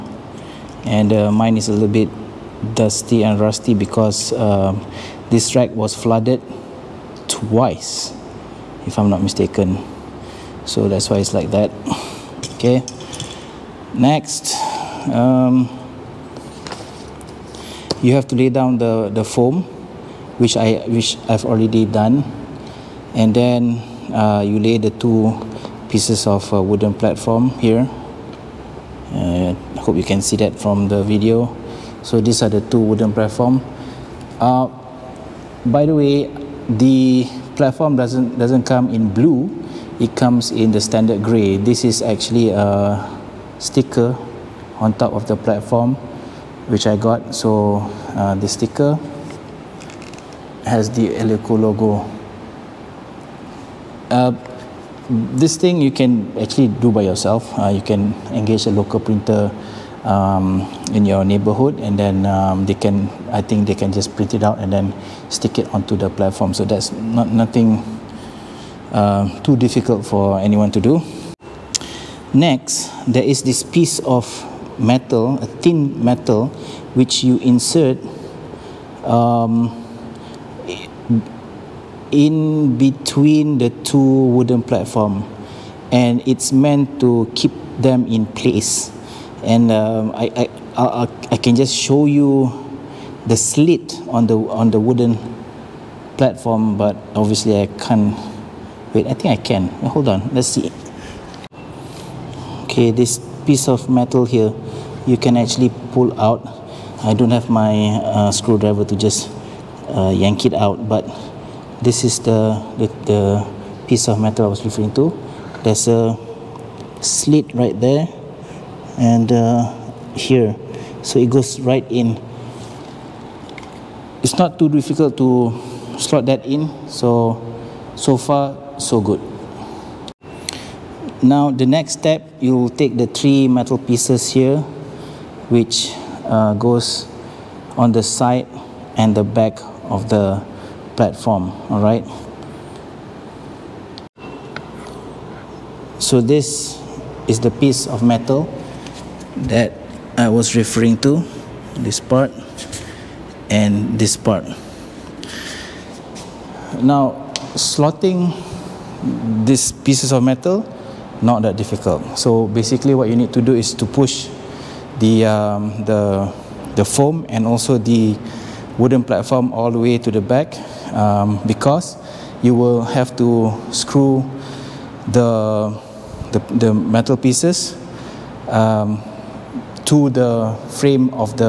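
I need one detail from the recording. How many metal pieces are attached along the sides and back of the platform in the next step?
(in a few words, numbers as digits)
3.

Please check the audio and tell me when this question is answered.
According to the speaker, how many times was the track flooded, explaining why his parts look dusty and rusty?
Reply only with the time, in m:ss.
0:07.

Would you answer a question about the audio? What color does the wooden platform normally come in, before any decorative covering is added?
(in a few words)
Gray.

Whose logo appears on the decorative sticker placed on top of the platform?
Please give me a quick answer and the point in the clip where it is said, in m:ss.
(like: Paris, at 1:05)
Eleco, at 0:51.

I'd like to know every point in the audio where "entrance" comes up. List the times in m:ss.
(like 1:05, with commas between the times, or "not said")
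not said.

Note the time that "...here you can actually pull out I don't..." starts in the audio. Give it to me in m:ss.
1:44.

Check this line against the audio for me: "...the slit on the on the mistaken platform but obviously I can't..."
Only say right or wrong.
wrong.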